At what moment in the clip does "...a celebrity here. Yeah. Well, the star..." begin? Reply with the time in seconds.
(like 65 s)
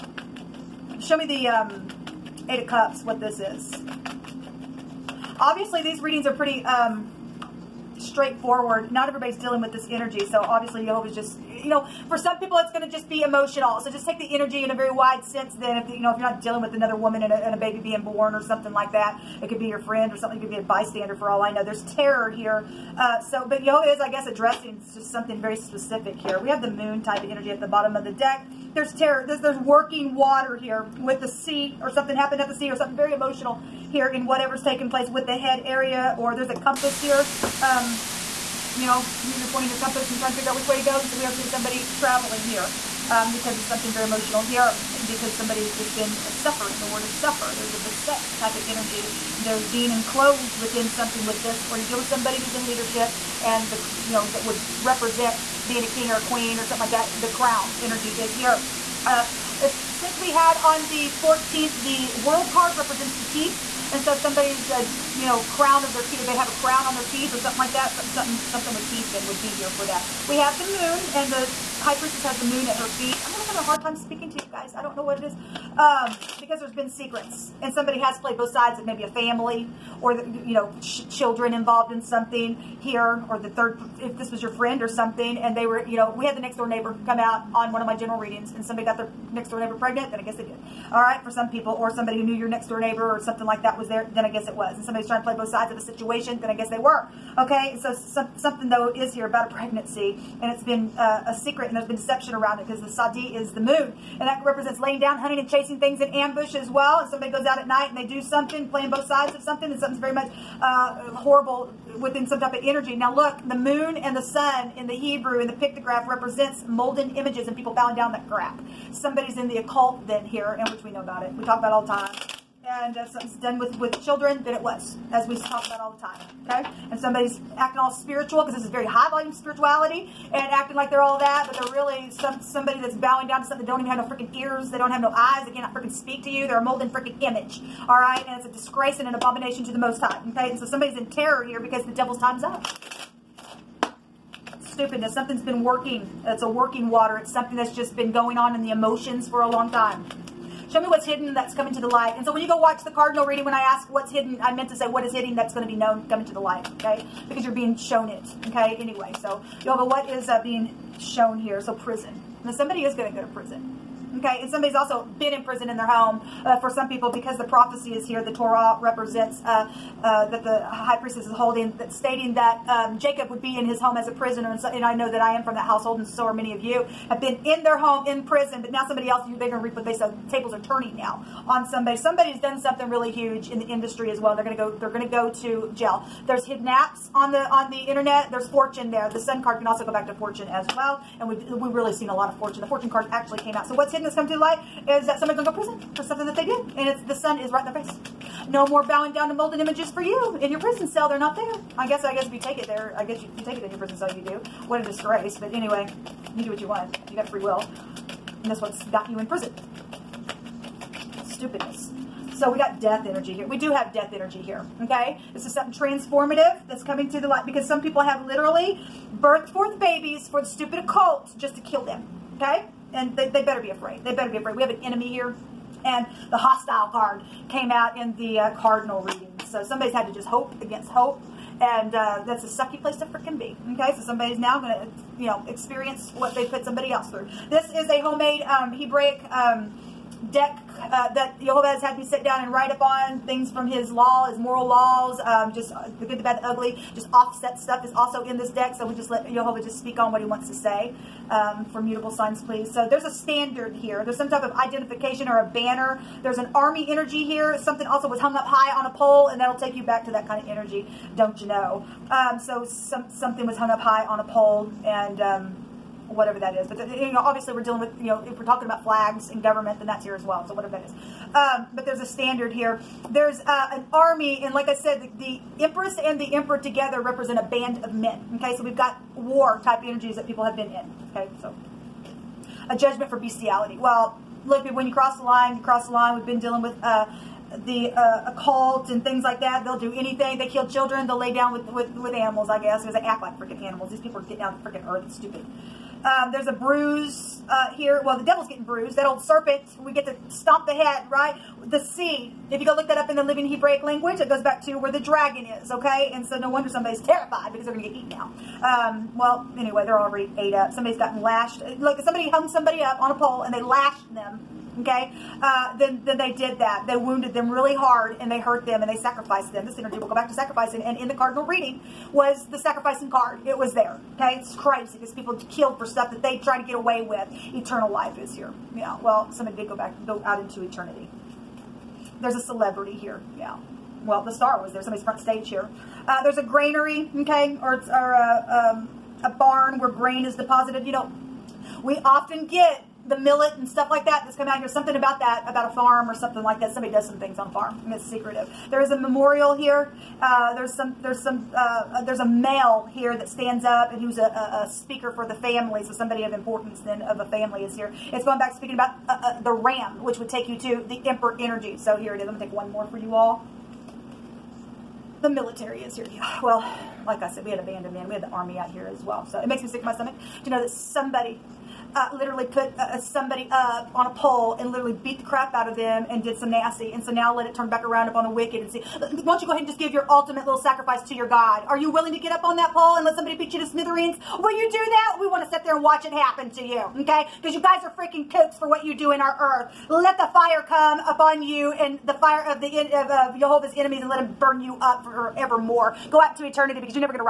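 332 s.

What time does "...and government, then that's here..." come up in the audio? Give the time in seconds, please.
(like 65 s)
269 s.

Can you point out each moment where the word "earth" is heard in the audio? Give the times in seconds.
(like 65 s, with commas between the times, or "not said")
294 s, 389 s.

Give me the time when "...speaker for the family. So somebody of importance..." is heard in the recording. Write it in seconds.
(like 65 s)
354 s.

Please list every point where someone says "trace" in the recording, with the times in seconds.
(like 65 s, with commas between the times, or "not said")
not said.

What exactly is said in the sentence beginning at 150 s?
Show me what's hidden that's coming to the light.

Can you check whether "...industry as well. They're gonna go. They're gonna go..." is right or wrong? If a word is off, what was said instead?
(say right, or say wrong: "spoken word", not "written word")
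right.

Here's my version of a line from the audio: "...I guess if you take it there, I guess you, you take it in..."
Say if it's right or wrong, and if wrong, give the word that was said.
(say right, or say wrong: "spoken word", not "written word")
right.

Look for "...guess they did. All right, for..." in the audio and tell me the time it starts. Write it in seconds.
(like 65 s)
90 s.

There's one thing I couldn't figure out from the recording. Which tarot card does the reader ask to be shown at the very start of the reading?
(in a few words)
Eight of Cups.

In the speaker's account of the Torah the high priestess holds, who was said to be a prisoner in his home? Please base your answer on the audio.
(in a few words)
Jacob.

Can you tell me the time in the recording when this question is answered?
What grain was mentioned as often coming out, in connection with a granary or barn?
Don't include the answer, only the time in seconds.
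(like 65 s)
343 s.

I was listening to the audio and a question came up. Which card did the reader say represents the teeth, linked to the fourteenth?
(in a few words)
The World.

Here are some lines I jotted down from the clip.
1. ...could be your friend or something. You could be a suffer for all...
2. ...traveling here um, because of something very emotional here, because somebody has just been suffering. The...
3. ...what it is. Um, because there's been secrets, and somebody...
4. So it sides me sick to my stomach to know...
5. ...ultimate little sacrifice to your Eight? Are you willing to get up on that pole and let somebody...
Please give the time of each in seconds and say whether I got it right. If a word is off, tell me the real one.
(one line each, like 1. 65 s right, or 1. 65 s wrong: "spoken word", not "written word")
1. 19 s wrong: "bystander", not "suffer"
2. 41 s right
3. 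75 s right
4. 369 s wrong: "makes", not "sides"
5. 380 s wrong: "God", not "Eight".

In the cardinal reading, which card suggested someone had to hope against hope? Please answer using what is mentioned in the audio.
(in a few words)
The hostile card.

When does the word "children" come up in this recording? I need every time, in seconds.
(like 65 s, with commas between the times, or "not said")
81 s, 124 s, 290 s.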